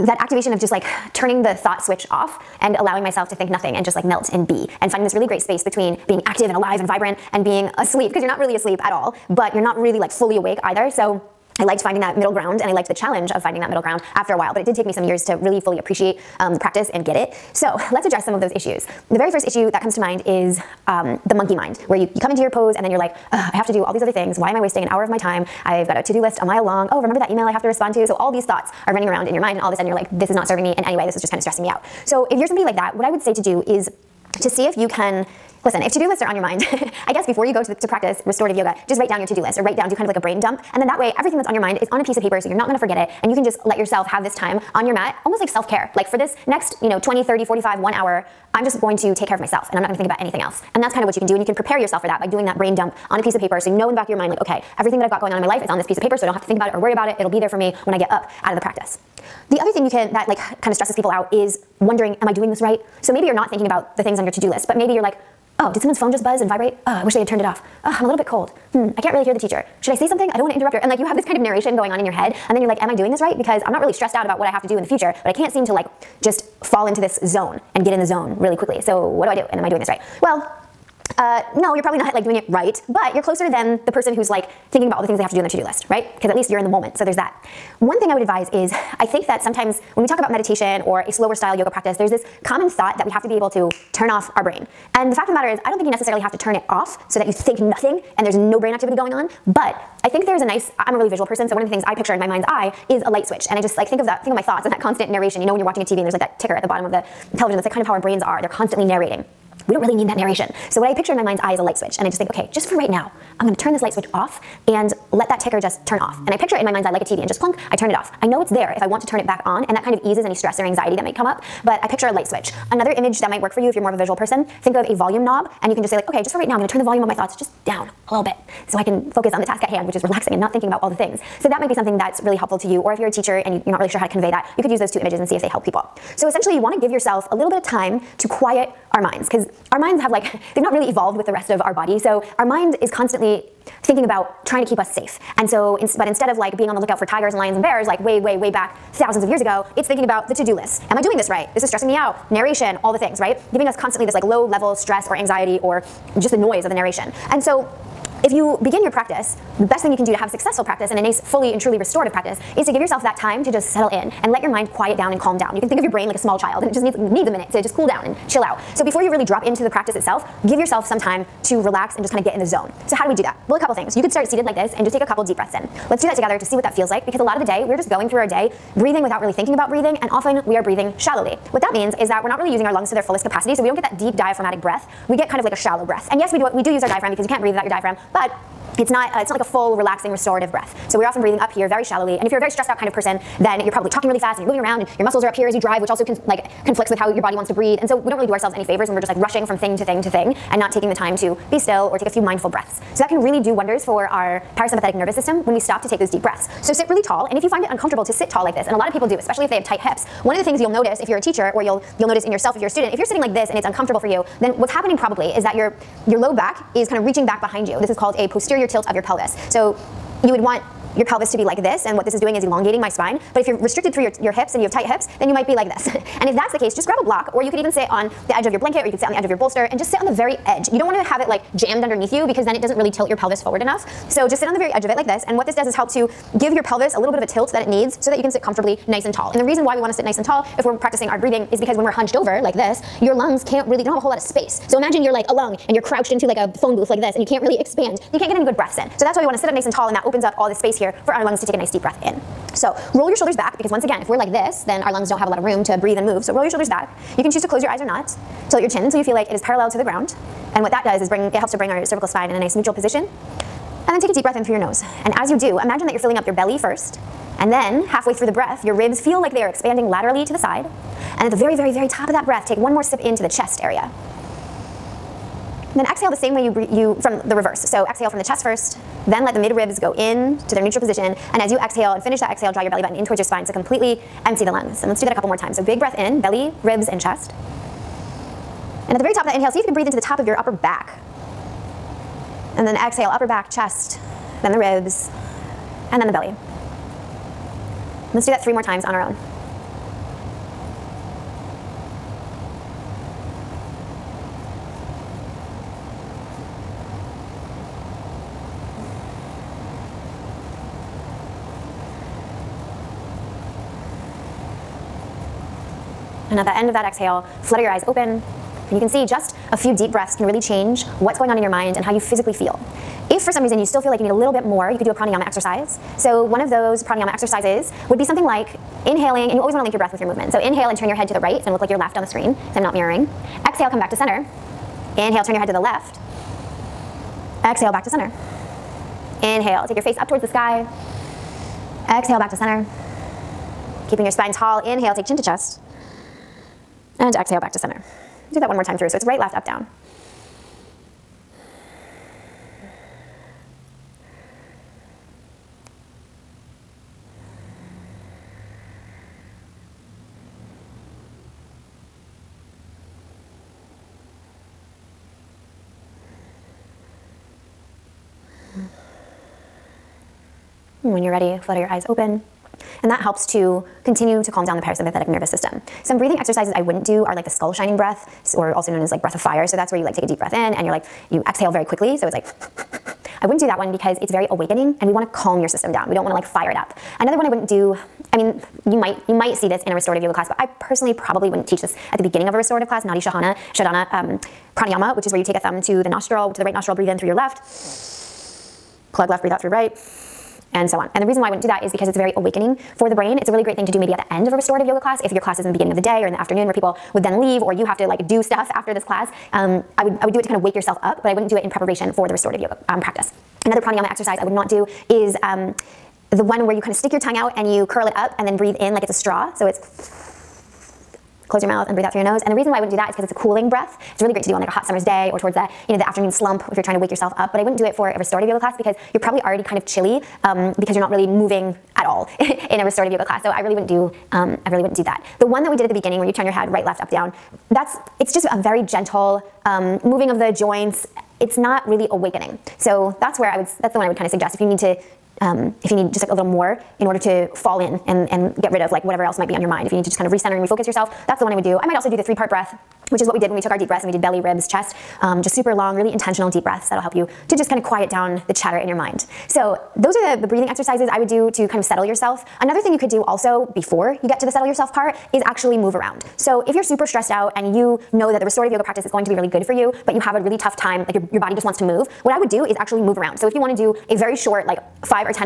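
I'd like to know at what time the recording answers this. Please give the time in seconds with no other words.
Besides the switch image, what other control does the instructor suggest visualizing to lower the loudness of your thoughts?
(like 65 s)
124 s.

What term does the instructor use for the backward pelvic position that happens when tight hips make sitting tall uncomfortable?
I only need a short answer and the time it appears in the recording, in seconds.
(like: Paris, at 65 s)
posterior tilt, at 218 s.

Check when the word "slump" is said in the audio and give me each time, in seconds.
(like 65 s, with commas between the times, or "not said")
426 s.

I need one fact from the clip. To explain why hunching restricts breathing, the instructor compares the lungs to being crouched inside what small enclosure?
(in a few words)
phone booth.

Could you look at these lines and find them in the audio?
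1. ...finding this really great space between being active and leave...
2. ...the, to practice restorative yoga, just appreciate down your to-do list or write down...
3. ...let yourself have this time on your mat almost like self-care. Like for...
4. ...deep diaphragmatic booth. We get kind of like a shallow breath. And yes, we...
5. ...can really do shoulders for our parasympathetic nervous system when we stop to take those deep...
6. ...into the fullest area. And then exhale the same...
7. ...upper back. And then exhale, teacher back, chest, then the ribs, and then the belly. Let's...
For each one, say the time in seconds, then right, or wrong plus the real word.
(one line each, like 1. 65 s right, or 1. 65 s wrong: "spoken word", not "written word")
1. 4 s wrong: "alive", not "leave"
2. 37 s wrong: "write", not "appreciate"
3. 43 s right
4. 183 s wrong: "breath", not "booth"
5. 203 s wrong: "wonders", not "shoulders"
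6. 272 s wrong: "chest", not "fullest"
7. 290 s wrong: "upper", not "teacher".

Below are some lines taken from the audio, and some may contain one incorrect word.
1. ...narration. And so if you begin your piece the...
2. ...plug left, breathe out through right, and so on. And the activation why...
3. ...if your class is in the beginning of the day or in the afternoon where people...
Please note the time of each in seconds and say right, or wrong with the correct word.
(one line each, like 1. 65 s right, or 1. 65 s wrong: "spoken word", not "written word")
1. 156 s wrong: "practice", not "piece"
2. 398 s wrong: "reason", not "activation"
3. 405 s right.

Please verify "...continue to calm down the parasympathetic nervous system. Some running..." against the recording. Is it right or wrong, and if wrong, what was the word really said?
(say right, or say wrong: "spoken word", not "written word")
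wrong: "breathing", not "running".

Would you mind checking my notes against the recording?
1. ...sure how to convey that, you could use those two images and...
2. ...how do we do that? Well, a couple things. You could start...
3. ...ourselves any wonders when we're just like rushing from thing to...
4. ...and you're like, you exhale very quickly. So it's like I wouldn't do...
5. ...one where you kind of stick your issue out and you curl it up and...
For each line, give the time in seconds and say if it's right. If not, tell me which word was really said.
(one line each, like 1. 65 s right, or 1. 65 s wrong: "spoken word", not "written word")
1. 133 s right
2. 172 s right
3. 198 s wrong: "favors", not "wonders"
4. 380 s right
5. 416 s wrong: "tongue", not "issue".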